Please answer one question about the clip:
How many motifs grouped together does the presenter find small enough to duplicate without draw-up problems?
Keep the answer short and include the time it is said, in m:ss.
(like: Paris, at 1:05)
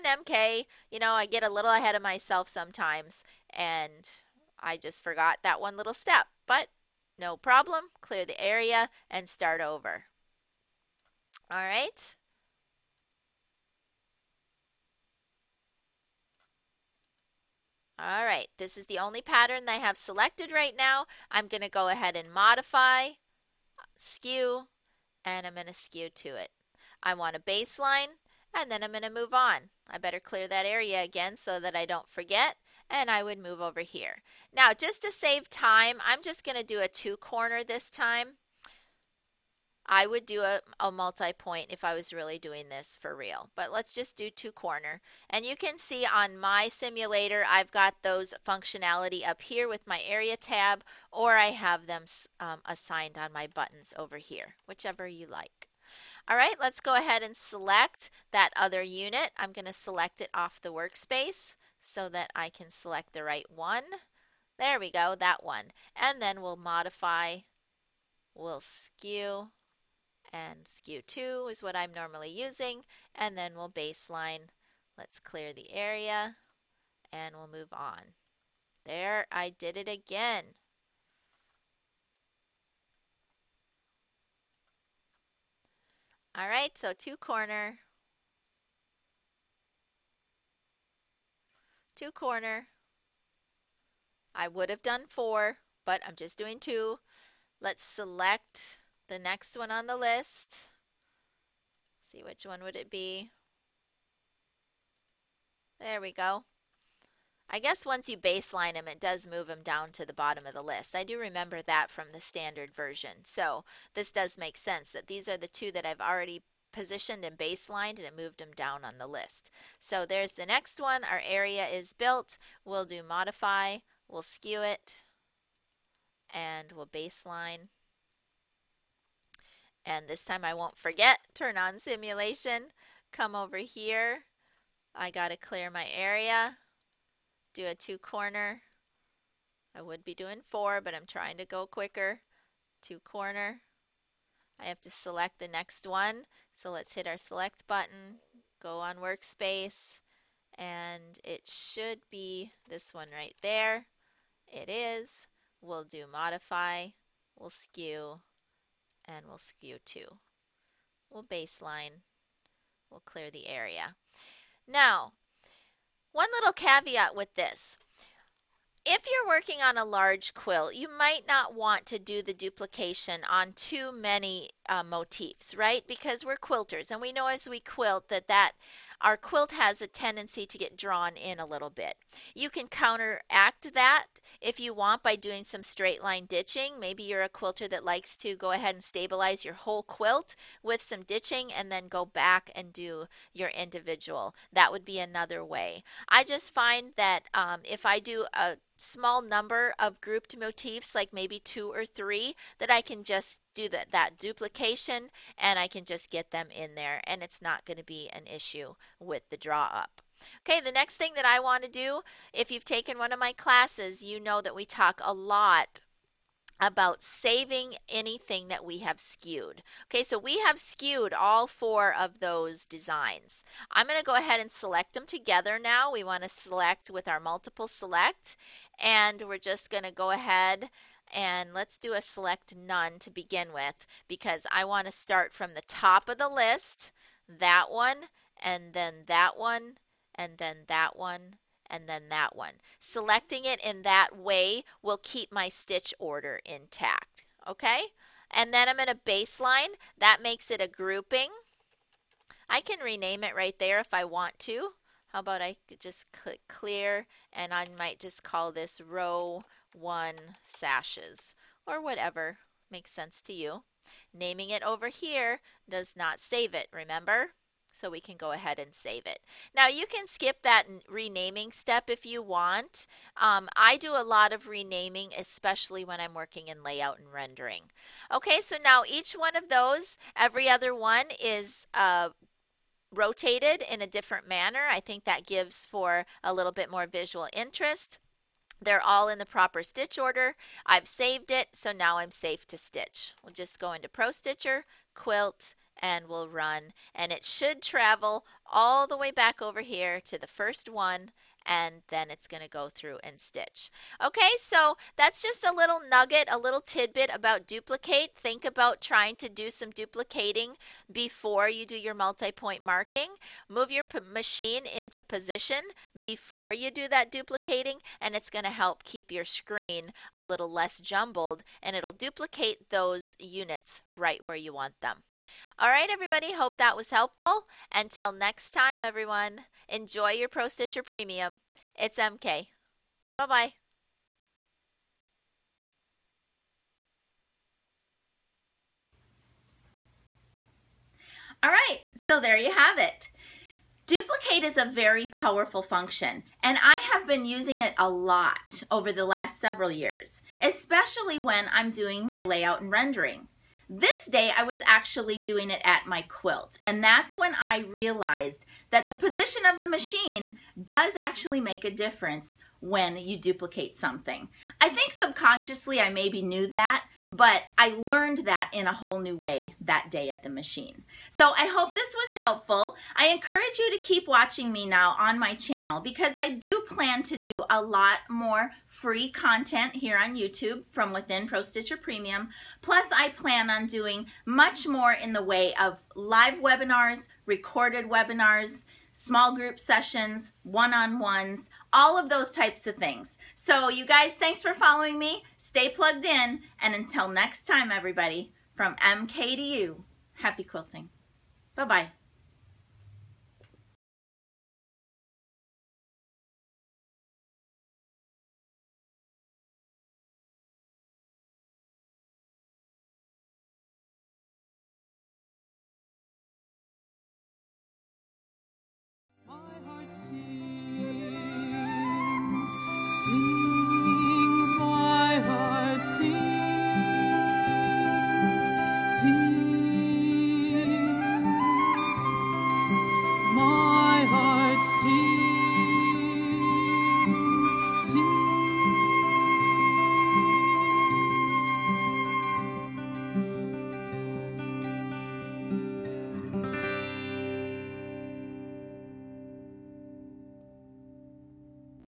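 two or three, at 3:21.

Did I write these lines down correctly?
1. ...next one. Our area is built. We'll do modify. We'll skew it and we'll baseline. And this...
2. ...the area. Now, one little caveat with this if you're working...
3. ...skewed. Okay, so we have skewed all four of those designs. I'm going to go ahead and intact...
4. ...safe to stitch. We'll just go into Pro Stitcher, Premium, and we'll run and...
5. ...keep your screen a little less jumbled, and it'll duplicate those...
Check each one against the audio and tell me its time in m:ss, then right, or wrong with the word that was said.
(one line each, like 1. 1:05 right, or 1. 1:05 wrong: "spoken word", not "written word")
1. 2:00 right
2. 2:43 right
3. 3:38 wrong: "select", not "intact"
4. 4:52 wrong: "Quilt", not "Premium"
5. 5:18 right.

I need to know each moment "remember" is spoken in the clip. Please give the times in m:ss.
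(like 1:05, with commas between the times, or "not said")
1:51, 4:26.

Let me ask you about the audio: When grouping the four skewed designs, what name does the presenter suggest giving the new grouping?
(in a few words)
row one sashes.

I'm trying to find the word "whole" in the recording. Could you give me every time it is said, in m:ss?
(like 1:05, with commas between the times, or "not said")
3:09, 6:08.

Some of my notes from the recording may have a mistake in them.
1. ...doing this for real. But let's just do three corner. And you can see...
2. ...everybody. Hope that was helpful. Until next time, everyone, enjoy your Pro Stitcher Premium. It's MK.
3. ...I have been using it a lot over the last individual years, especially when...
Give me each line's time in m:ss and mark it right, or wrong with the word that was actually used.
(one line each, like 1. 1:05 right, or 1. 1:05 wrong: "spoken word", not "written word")
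1. 0:42 wrong: "two", not "three"
2. 5:25 right
3. 5:46 wrong: "several", not "individual".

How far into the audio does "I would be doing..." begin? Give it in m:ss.
2:19.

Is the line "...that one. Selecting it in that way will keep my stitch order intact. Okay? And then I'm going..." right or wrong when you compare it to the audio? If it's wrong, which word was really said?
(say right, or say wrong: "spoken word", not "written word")
right.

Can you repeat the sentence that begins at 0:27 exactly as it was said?
I want a baseline and then I'm going to move on.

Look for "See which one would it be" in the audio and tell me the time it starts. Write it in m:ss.
1:42.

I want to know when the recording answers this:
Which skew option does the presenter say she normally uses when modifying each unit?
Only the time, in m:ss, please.
1:10.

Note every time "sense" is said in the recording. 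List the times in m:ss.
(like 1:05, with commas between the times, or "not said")
1:54, 4:22.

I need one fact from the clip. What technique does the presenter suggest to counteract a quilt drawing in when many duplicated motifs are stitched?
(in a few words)
straight line ditching.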